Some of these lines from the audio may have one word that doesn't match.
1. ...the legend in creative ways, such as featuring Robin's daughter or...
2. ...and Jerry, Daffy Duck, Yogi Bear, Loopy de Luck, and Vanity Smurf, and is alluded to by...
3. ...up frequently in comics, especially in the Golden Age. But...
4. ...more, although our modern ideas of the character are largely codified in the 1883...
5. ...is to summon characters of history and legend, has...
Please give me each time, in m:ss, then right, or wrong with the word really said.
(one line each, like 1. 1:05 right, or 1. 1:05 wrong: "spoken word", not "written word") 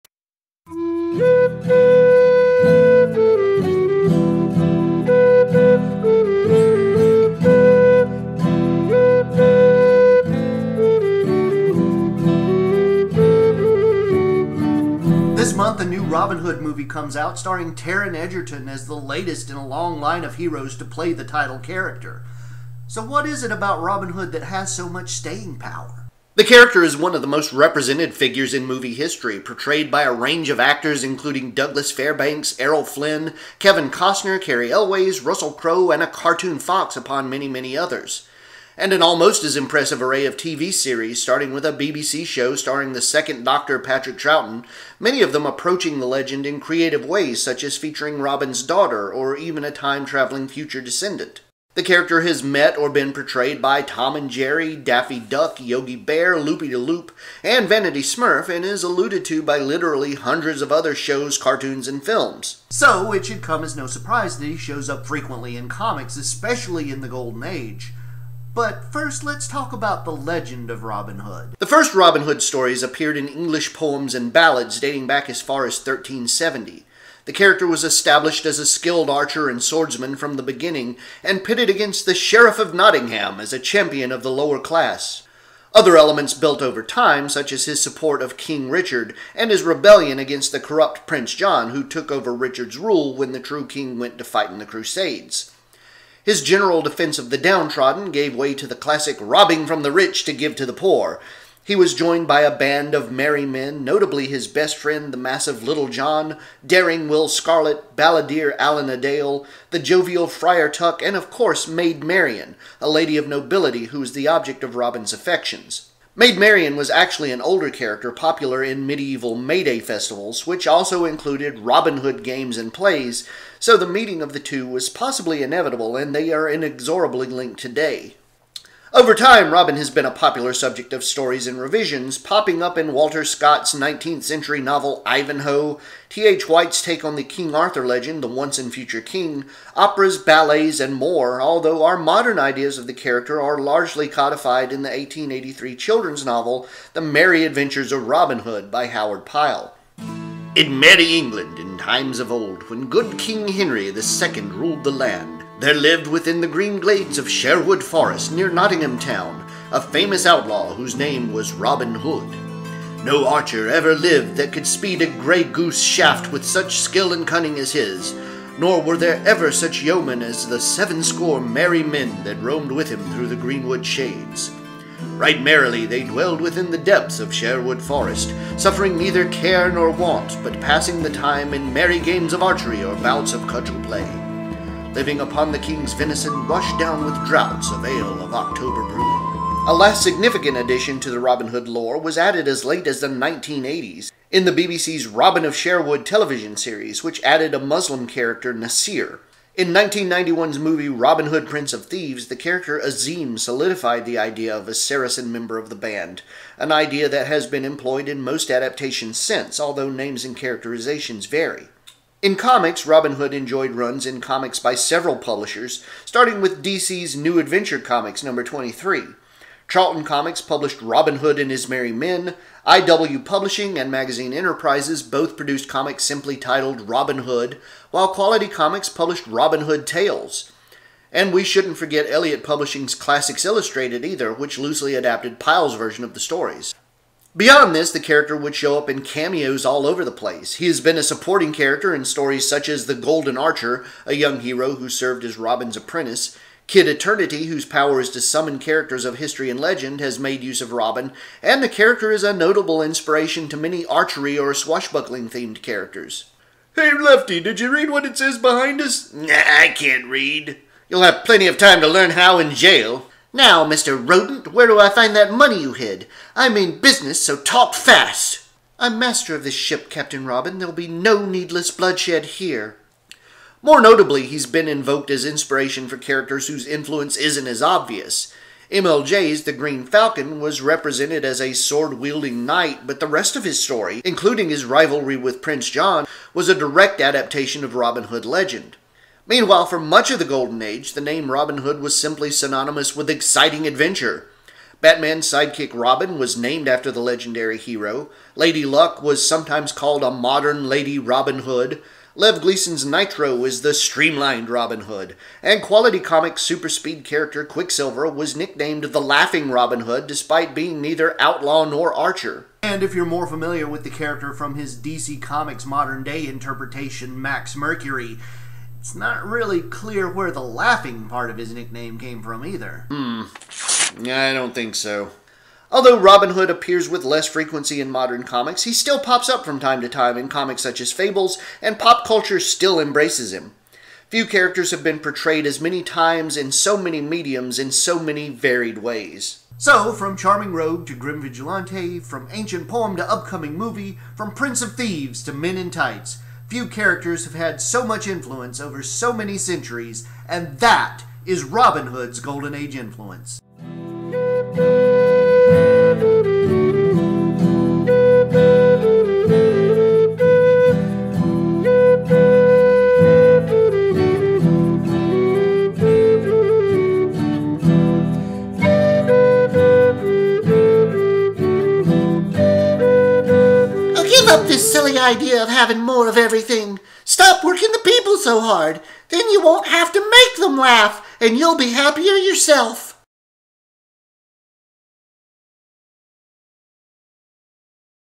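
1. 0:45 right
2. 0:54 wrong: "Loop", not "Luck"
3. 1:04 right
4. 2:20 right
5. 4:08 right.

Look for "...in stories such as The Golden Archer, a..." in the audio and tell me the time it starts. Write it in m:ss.
4:01.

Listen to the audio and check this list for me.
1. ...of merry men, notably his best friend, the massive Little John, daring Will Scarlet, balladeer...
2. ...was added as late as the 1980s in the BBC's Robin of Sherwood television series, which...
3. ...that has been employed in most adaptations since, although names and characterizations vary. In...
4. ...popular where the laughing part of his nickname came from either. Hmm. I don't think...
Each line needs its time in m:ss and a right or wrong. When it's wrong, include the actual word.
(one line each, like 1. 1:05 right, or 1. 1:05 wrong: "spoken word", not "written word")
1. 1:42 right
2. 3:11 right
3. 3:27 right
4. 5:19 wrong: "clear", not "popular".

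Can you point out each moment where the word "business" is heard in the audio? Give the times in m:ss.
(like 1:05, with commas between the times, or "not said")
4:26.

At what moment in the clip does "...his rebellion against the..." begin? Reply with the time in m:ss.
1:29.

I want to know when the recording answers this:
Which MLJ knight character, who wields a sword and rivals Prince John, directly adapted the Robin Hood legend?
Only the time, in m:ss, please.
4:39.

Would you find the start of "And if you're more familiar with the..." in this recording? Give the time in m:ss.
5:12.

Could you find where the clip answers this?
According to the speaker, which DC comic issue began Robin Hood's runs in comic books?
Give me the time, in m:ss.
3:37.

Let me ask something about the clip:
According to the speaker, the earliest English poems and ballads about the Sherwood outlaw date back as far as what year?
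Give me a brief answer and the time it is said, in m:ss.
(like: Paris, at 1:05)
1370, at 1:15.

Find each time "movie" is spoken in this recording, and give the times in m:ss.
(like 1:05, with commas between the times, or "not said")
0:16, 0:28, 3:20, 5:43.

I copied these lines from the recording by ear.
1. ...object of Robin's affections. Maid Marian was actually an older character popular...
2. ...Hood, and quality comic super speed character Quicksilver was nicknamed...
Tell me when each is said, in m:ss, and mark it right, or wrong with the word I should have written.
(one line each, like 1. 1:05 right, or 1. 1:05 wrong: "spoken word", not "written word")
1. 1:54 right
2. 5:04 right.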